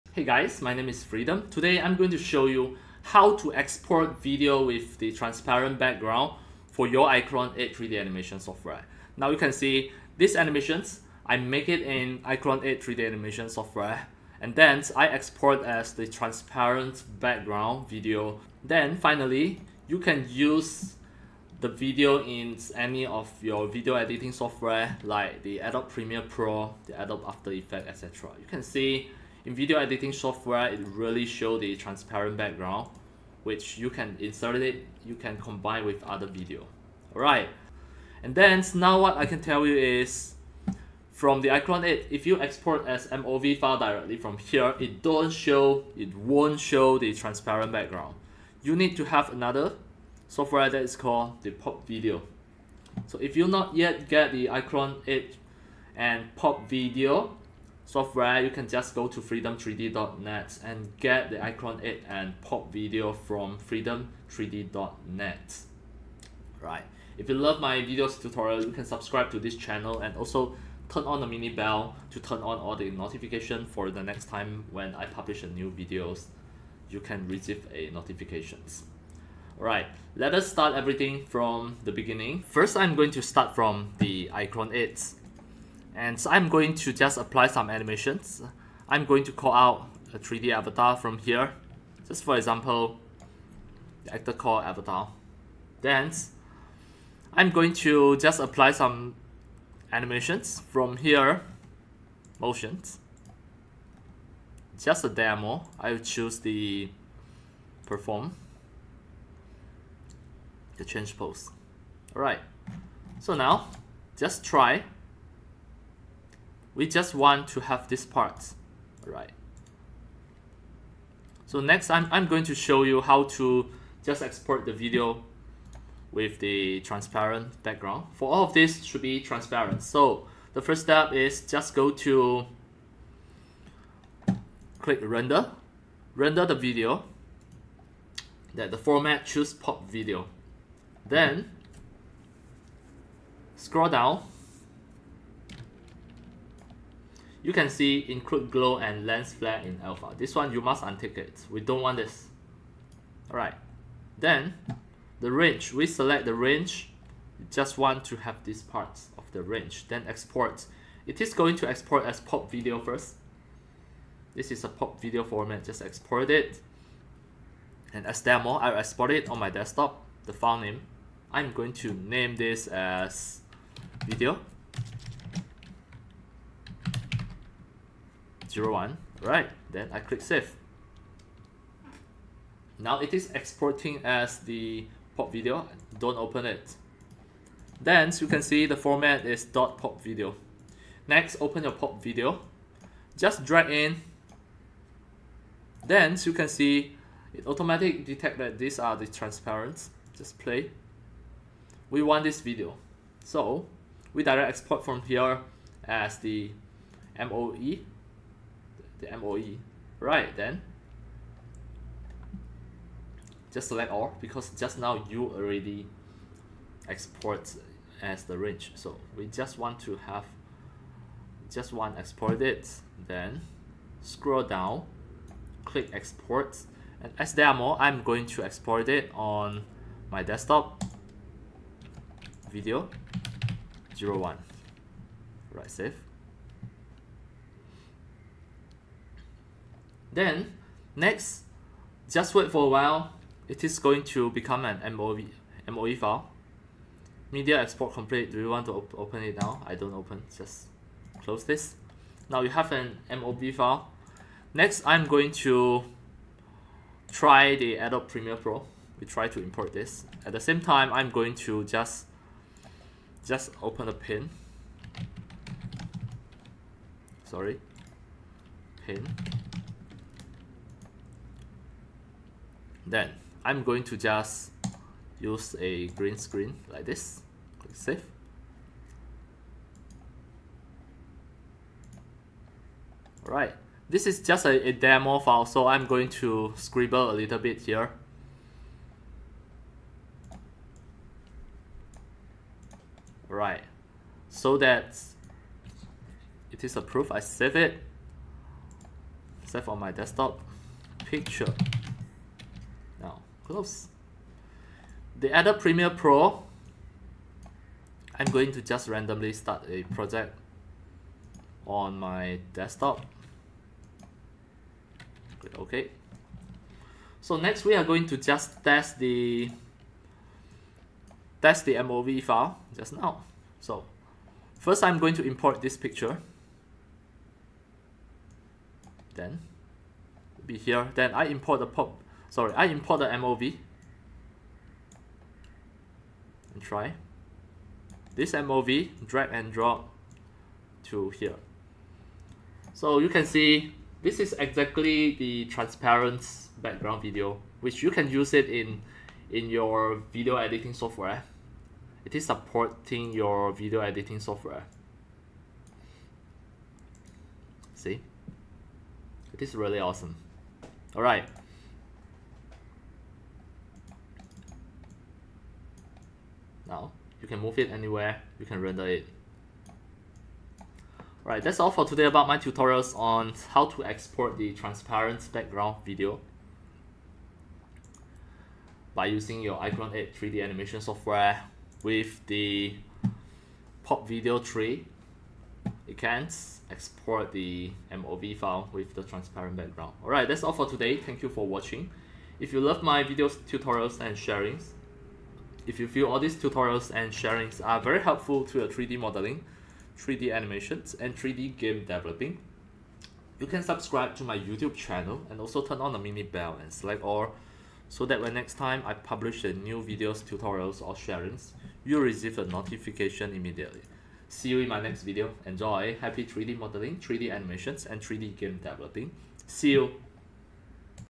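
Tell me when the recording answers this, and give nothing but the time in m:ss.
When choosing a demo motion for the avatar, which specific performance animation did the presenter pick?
1:50.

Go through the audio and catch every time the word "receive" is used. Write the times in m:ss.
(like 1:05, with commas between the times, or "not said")
1:17, 6:52.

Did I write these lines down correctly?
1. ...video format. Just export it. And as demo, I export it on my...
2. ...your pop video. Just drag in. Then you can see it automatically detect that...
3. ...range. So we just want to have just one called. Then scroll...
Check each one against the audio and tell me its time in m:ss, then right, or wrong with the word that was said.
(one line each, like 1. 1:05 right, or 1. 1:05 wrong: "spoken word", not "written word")
1. 2:45 right
2. 3:11 right
3. 3:38 wrong: "exported", not "called".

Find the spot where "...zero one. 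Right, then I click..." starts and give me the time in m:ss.
2:58.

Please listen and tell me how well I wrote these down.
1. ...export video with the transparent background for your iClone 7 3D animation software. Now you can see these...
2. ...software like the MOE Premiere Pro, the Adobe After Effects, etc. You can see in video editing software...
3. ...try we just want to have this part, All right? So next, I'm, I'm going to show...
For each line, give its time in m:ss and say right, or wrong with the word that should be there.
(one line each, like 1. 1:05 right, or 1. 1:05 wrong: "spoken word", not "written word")
1. 0:03 wrong: "8", not "7"
2. 0:24 wrong: "Adobe", not "MOE"
3. 1:54 right.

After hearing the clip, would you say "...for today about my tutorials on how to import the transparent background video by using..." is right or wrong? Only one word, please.
wrong.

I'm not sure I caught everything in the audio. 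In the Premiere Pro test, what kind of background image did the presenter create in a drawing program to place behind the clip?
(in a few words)
green screen.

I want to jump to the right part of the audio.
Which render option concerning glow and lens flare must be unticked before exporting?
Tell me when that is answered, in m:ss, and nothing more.
2:28.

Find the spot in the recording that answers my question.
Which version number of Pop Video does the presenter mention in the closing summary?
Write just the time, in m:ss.
6:23.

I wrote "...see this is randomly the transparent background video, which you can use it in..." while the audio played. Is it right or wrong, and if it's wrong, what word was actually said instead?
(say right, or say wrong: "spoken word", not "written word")
wrong: "exactly", not "randomly".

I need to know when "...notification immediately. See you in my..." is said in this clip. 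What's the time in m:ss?
6:52.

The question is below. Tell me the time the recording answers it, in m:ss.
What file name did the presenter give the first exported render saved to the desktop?
2:54.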